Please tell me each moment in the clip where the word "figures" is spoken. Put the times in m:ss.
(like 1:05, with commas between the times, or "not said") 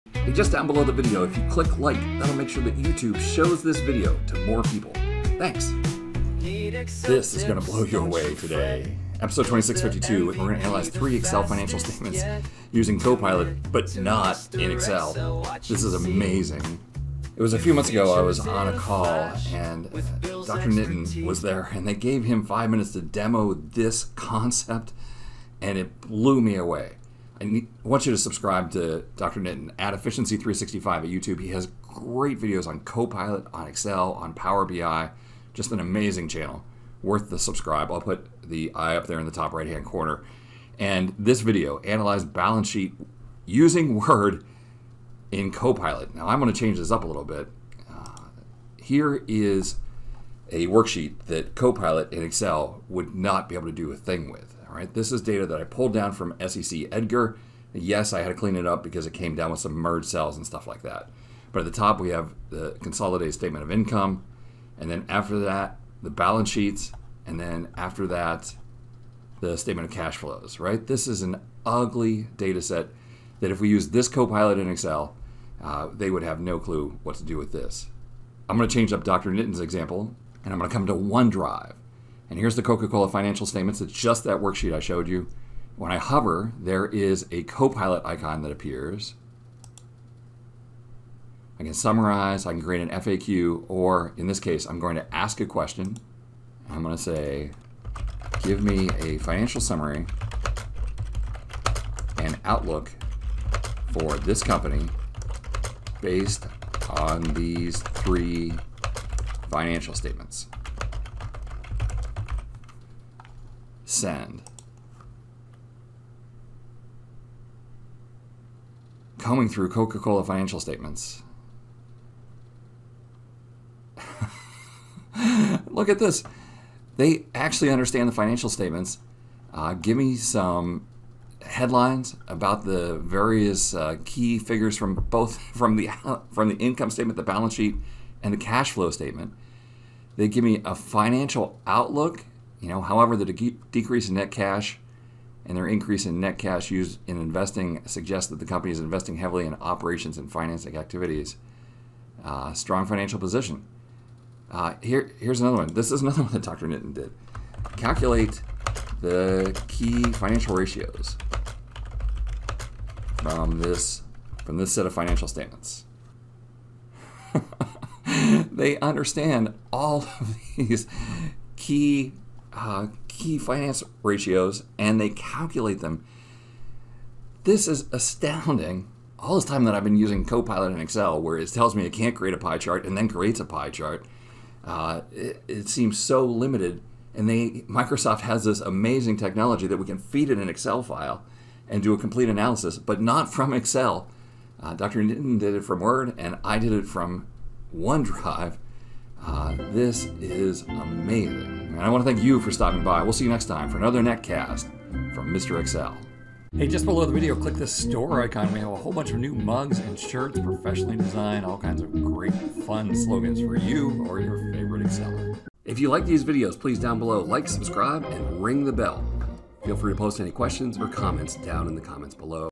2:14.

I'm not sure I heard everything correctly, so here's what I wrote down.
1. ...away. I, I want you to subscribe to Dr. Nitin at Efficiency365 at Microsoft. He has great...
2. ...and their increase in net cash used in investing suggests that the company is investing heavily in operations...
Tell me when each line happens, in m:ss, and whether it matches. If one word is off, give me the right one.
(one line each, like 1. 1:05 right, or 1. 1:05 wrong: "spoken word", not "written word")
1. 0:26 wrong: "YouTube", not "Microsoft"
2. 2:25 right.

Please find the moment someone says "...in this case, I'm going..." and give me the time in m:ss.
1:34.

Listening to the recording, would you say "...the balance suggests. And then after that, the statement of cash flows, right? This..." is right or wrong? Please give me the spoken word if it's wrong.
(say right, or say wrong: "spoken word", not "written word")
wrong: "sheets", not "suggests".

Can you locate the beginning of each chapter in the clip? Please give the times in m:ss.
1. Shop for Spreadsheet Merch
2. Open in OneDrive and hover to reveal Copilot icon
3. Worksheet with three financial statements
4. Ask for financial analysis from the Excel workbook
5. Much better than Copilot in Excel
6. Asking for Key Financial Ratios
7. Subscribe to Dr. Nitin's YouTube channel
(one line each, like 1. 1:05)
1. 3:26
2. 1:20
3. 0:49
4. 1:40
5. 3:01
6. 2:35
7. 0:20.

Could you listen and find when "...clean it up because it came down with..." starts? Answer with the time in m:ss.
0:58.